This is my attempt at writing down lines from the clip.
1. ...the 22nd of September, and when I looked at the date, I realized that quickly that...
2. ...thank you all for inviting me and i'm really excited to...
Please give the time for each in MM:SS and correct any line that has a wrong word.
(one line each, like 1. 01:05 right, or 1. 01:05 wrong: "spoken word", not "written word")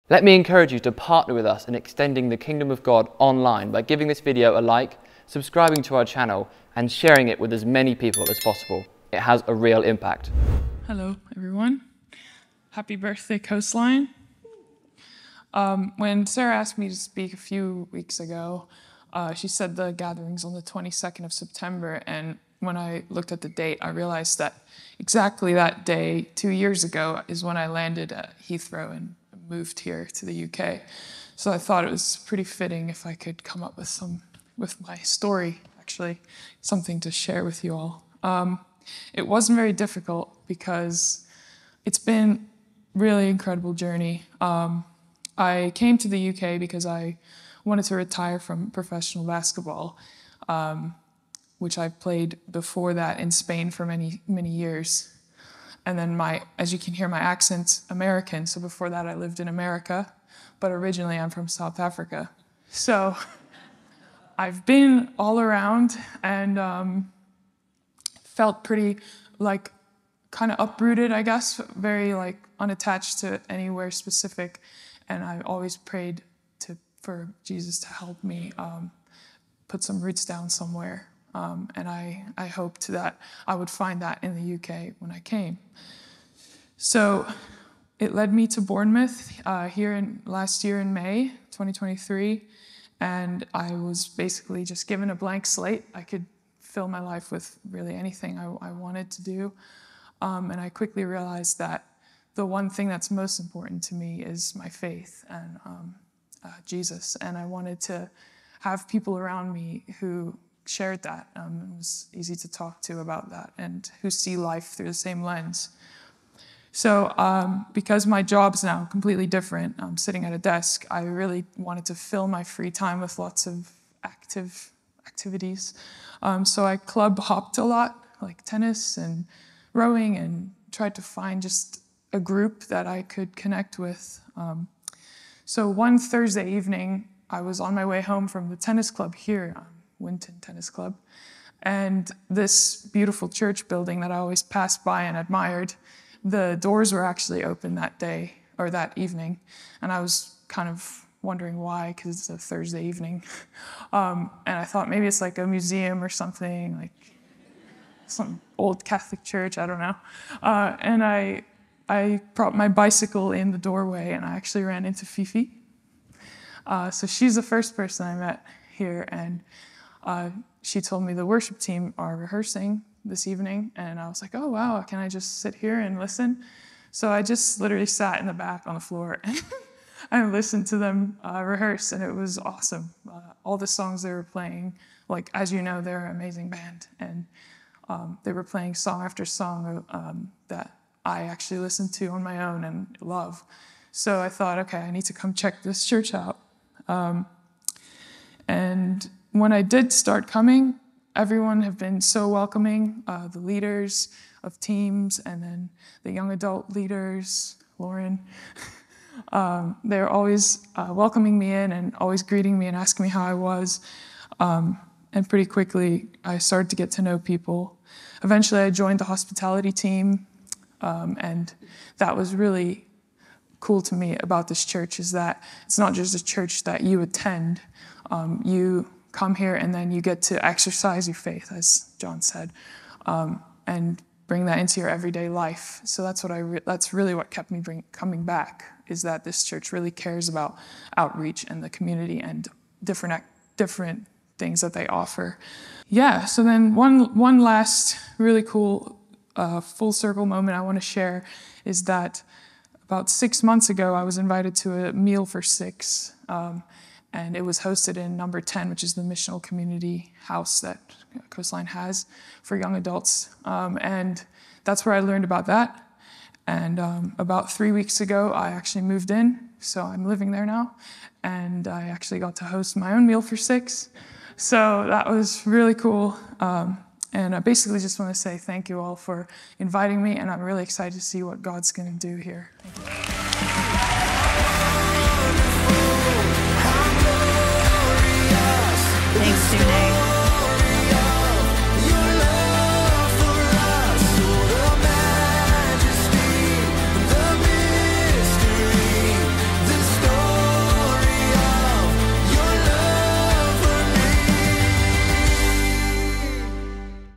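1. 00:20 wrong: "exactly", not "quickly"
2. 04:38 right.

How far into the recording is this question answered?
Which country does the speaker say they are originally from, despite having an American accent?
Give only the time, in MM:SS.
01:01.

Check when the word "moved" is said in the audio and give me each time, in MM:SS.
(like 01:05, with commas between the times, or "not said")
00:29, 04:28.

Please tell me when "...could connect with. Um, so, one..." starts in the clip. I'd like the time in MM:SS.
02:13.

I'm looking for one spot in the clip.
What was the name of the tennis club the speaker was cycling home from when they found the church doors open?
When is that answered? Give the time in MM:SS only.
02:20.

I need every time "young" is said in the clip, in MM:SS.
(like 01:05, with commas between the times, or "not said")
03:26, 04:22.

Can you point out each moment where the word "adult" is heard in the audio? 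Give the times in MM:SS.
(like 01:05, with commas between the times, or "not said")
03:26, 04:22.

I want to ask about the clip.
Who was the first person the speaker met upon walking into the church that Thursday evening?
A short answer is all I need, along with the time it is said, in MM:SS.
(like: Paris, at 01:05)
Fifi, at 02:45.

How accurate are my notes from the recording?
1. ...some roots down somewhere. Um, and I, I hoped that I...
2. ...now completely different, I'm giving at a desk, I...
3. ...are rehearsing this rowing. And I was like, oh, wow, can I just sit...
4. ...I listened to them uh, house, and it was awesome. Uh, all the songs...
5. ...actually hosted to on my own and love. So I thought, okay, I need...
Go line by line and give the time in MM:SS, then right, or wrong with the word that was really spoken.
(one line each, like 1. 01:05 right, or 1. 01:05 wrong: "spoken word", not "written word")
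1. 01:19 right
2. 01:58 wrong: "sitting", not "giving"
3. 02:51 wrong: "evening", not "rowing"
4. 03:00 wrong: "rehearse", not "house"
5. 03:11 wrong: "listened", not "hosted".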